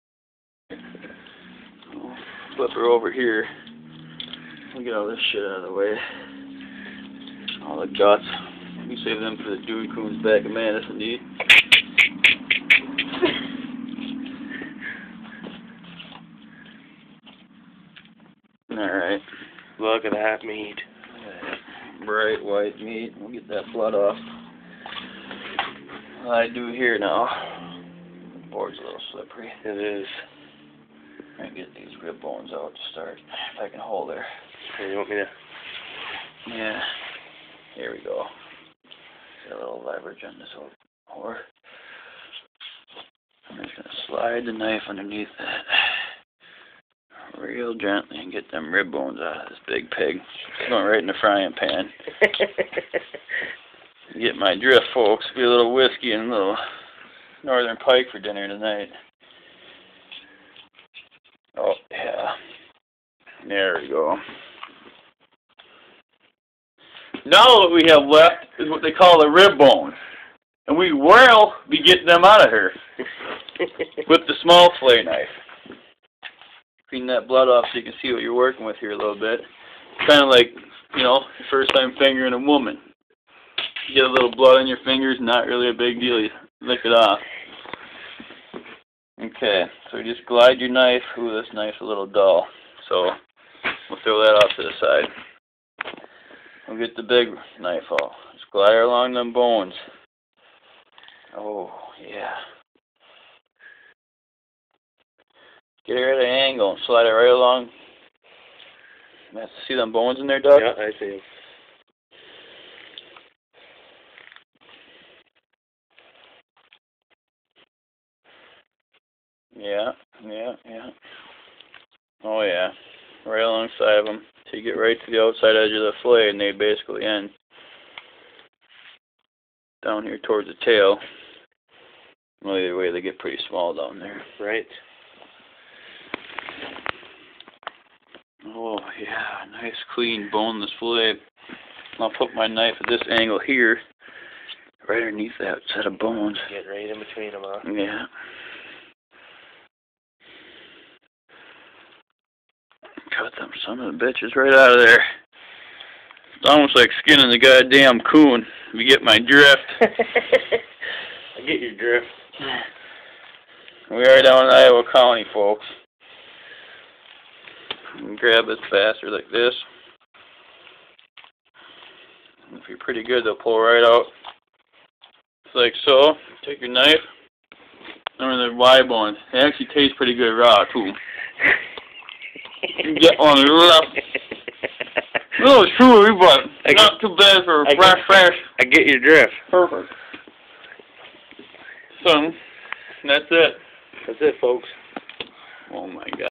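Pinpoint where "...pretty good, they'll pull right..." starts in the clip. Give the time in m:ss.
2:52.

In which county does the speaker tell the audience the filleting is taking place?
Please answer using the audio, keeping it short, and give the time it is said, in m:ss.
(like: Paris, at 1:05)
Iowa County, at 2:44.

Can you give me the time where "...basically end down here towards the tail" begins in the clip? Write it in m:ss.
2:06.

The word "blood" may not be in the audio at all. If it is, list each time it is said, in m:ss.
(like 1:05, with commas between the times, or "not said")
0:23, 1:17, 1:24.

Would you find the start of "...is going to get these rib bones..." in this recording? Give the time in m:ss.
0:30.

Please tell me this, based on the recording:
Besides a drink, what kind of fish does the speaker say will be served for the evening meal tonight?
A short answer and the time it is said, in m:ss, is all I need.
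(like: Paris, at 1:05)
Northern pike, at 0:57.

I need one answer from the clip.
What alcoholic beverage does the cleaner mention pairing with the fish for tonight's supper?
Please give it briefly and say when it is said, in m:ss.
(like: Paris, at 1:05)
Whiskey, at 0:55.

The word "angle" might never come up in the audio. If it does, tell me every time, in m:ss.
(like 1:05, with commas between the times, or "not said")
1:46, 2:23.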